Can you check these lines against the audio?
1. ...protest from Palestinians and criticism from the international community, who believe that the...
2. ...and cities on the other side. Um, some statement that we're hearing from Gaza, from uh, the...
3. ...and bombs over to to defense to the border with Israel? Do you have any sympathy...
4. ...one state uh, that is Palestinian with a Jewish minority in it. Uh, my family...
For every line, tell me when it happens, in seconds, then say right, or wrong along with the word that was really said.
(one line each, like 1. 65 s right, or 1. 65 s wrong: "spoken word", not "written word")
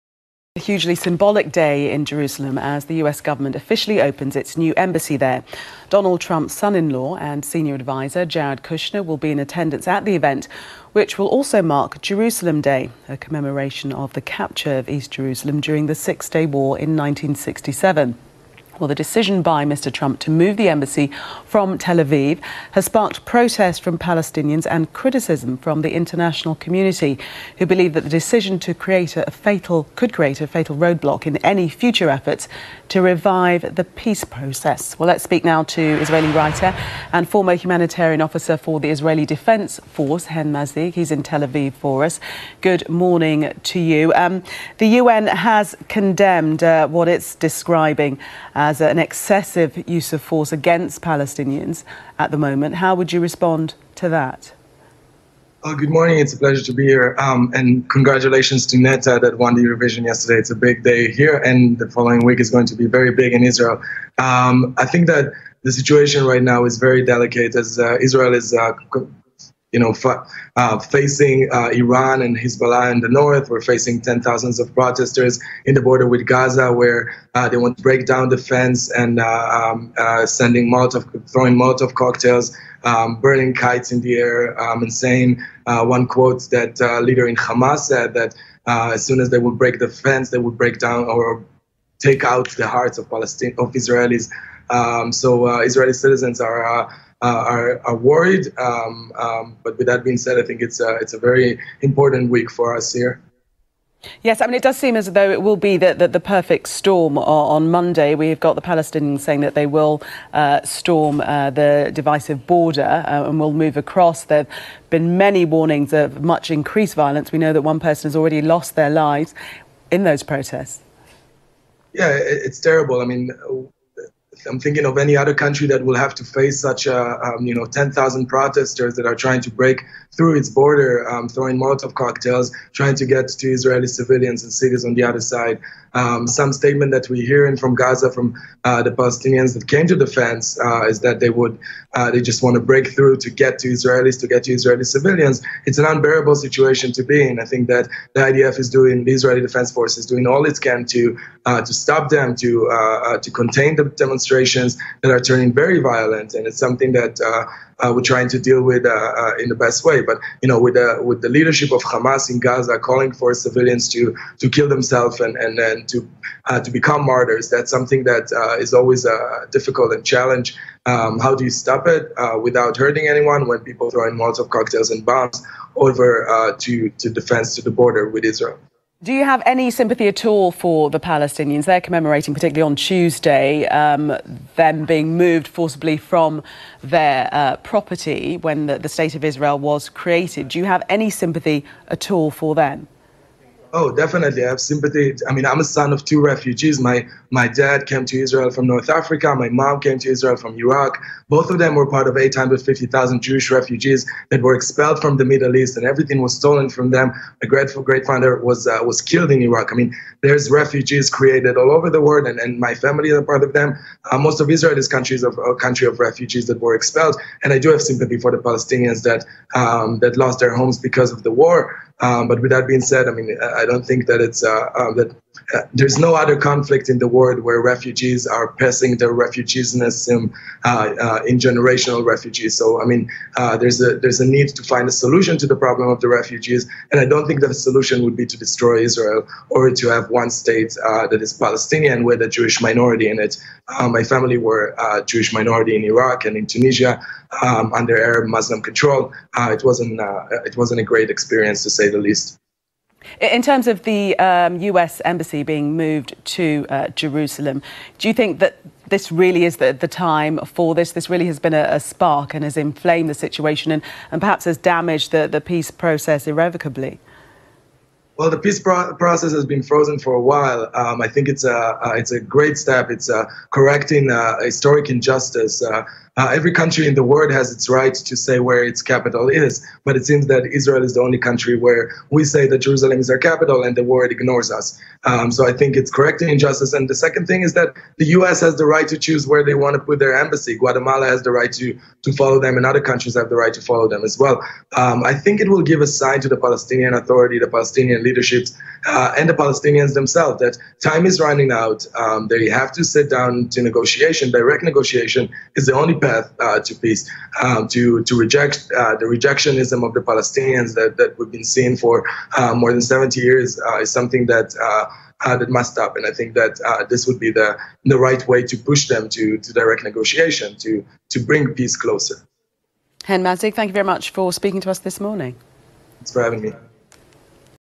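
1. 23 s right
2. 134 s right
3. 174 s right
4. 240 s right.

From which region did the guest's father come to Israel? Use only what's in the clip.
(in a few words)
North Africa.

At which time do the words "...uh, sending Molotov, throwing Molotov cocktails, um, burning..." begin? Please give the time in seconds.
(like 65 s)
79 s.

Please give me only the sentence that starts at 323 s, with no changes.
Hen Mazzig, thank you very much for speaking to us this morning.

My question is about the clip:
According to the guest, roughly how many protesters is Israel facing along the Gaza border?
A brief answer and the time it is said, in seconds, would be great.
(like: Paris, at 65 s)
10,000, at 127 s.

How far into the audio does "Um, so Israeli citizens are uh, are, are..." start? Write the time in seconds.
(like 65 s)
94 s.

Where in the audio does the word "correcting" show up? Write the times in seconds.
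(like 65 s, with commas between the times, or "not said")
273 s, 285 s.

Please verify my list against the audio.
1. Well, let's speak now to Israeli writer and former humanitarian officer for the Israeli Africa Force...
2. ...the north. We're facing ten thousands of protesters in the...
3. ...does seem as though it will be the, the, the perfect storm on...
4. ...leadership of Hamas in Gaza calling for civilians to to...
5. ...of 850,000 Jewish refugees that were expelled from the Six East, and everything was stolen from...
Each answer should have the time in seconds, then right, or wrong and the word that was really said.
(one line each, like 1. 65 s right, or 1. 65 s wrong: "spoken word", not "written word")
1. 34 s wrong: "Defense", not "Africa"
2. 72 s right
3. 104 s right
4. 161 s right
5. 202 s wrong: "Middle", not "Six".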